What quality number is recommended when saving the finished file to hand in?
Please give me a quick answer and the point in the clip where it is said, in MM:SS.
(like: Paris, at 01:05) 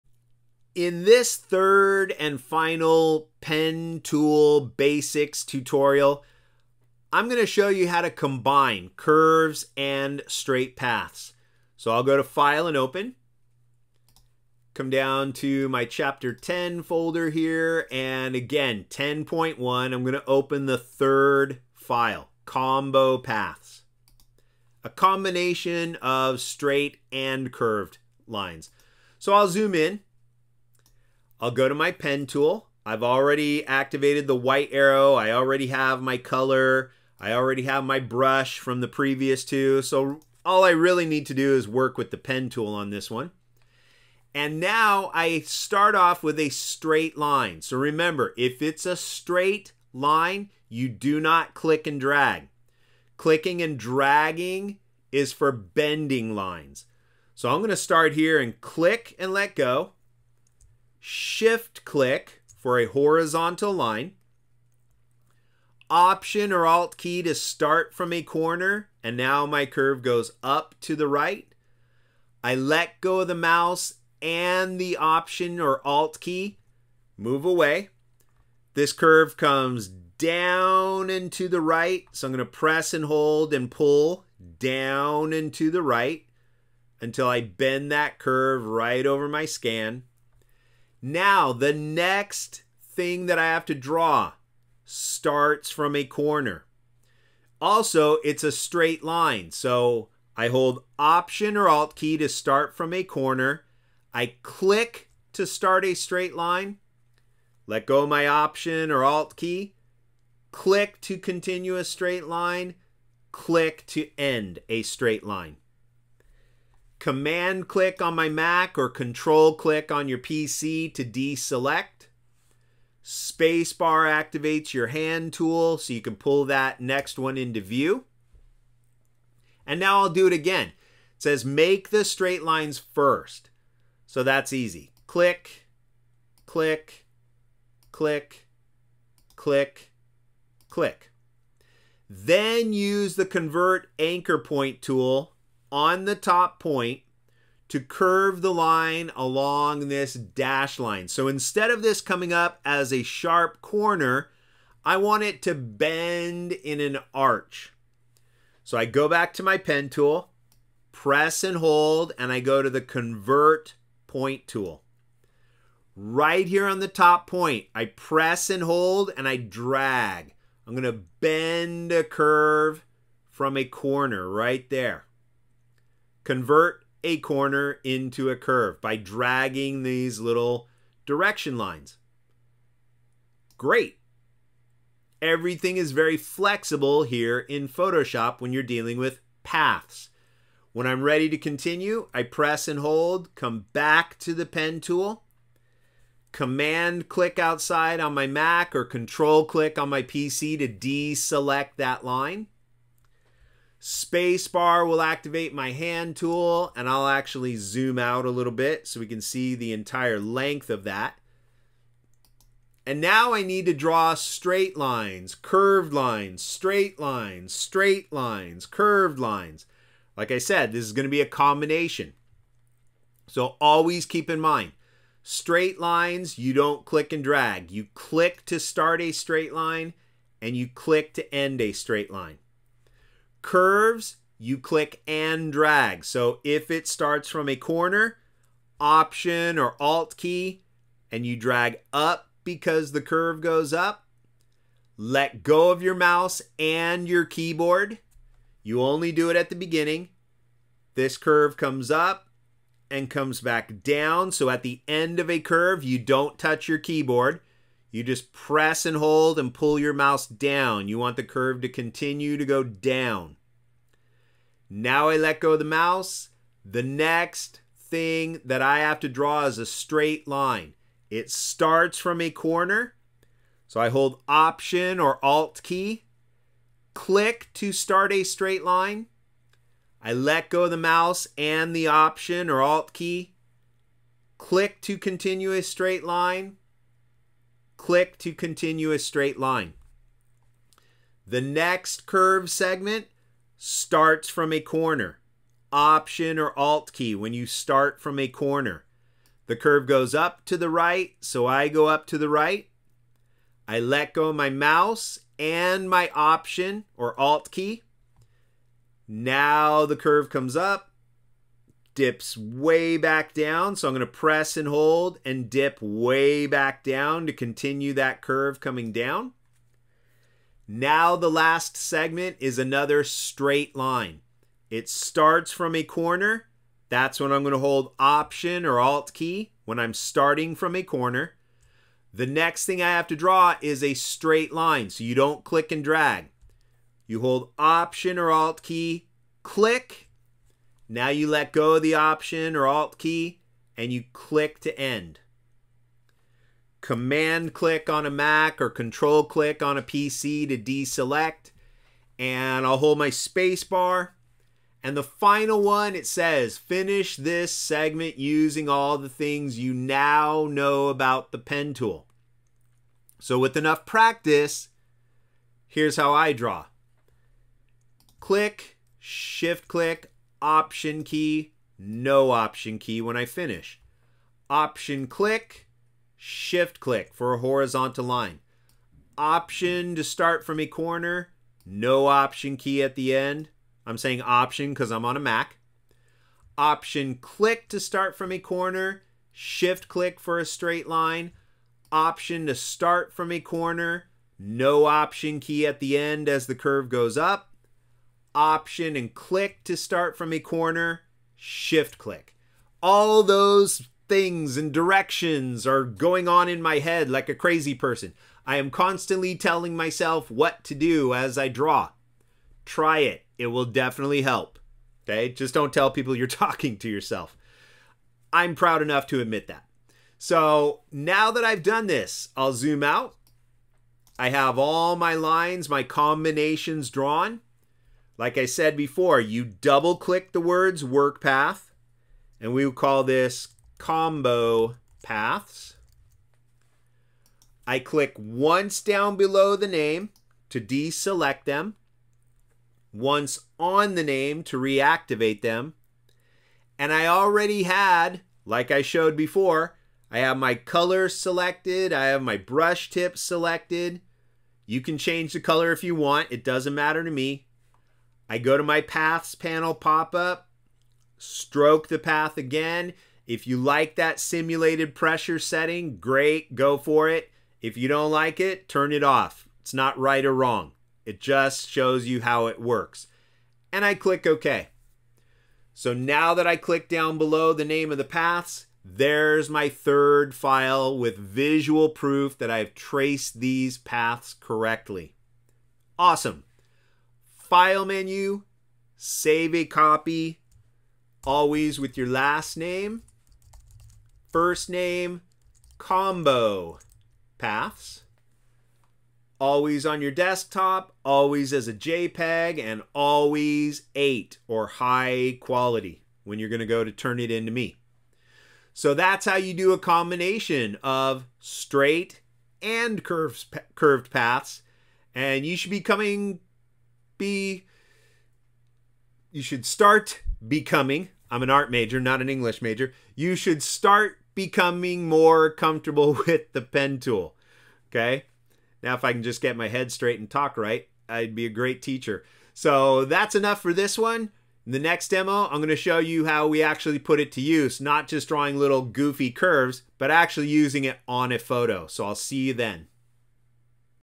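8, at 08:23.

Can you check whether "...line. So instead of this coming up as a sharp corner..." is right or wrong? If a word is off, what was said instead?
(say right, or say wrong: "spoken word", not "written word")
right.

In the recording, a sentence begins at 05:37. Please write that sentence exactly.
You hold Option or Alt key, click.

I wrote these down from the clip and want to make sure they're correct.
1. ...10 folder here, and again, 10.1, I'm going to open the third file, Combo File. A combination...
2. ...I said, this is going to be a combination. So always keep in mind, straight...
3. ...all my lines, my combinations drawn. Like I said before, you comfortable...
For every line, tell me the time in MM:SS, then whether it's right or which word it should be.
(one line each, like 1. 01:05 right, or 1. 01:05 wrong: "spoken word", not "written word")
1. 00:16 wrong: "Paths", not "File"
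2. 03:40 right
3. 07:04 wrong: "double", not "comfortable".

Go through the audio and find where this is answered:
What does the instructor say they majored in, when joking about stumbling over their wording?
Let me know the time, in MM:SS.
08:41.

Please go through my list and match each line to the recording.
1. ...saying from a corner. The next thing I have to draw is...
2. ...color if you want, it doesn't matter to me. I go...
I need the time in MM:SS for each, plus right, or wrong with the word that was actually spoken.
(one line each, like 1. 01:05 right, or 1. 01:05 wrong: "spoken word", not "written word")
1. 05:29 wrong: "starting", not "saying"
2. 07:35 right.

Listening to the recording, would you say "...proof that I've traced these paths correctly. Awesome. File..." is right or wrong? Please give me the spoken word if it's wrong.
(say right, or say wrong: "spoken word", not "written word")
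right.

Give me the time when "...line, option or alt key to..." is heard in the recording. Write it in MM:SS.
01:03.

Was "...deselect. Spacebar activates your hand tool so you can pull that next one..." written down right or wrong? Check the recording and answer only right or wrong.
right.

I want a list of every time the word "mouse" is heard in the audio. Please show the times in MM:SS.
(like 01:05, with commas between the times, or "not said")
01:13, 04:05, 04:19, 04:25, 04:40, 05:04.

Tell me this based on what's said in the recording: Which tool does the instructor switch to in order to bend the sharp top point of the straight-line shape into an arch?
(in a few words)
convert point tool.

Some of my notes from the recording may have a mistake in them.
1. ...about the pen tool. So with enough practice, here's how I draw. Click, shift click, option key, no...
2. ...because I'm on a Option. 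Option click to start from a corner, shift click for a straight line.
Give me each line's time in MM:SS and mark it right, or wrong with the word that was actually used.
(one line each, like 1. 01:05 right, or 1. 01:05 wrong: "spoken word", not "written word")
1. 06:00 right
2. 06:24 wrong: "Mac", not "Option".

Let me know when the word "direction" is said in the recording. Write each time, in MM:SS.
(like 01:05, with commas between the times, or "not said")
03:01, 06:44.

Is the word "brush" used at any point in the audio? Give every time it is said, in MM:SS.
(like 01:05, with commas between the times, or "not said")
00:37, 07:32.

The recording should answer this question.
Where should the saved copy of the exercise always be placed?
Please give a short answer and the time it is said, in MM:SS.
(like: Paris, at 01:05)
desktop, at 08:20.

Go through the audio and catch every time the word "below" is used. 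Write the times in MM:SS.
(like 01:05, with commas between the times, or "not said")
07:19, 07:57.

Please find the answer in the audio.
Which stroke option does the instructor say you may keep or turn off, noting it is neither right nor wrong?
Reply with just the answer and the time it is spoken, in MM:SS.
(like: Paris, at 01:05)
simulated pressure, at 07:44.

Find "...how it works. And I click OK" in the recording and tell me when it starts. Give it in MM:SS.
07:52.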